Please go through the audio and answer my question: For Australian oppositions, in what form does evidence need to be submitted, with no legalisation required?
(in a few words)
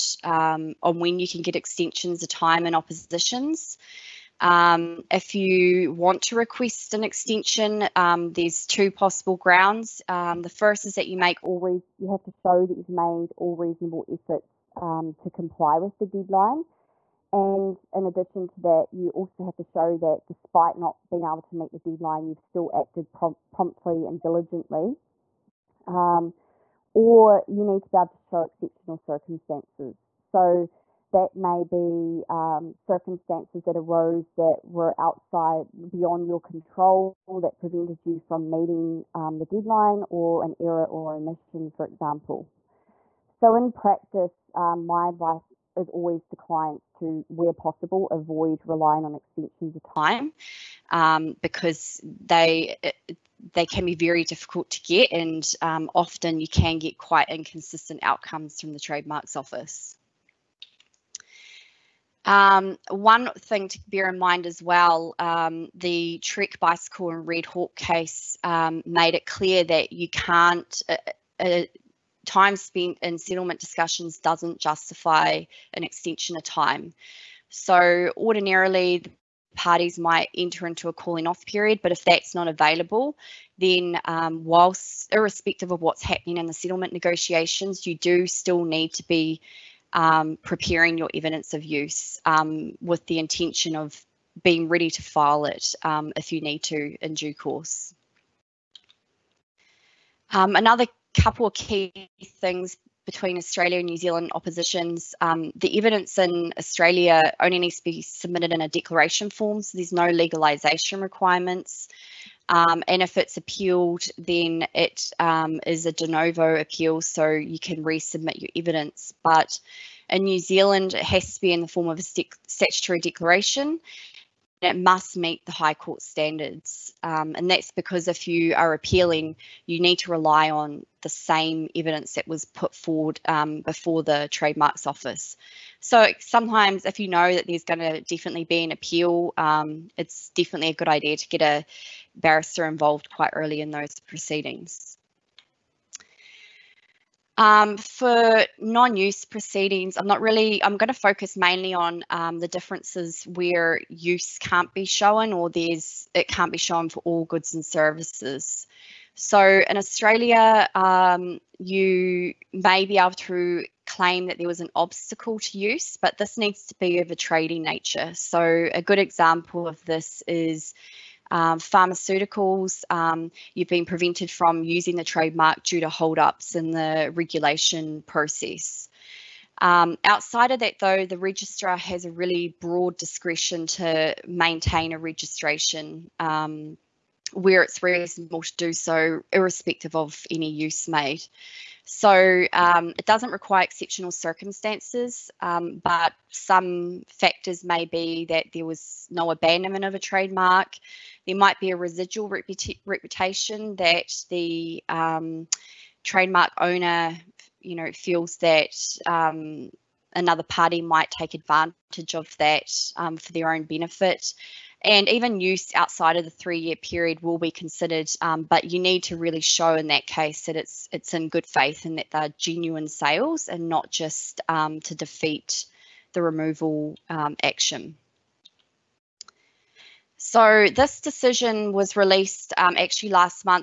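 Declaration form.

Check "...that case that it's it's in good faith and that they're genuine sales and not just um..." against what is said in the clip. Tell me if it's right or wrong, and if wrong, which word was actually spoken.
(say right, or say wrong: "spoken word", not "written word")
right.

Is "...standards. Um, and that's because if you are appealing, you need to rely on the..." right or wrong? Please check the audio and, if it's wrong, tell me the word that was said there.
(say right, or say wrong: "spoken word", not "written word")
right.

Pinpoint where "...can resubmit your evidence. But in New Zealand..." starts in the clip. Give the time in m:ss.
1:57.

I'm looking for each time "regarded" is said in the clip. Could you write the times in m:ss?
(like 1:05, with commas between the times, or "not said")
not said.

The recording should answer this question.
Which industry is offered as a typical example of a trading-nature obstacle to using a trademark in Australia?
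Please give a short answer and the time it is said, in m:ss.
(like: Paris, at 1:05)
Pharmaceuticals, at 2:51.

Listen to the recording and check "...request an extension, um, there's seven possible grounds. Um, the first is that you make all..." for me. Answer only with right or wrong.
wrong.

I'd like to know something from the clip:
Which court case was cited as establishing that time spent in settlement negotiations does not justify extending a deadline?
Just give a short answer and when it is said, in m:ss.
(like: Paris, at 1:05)
Trek Bicycle and Red Hawk, at 1:06.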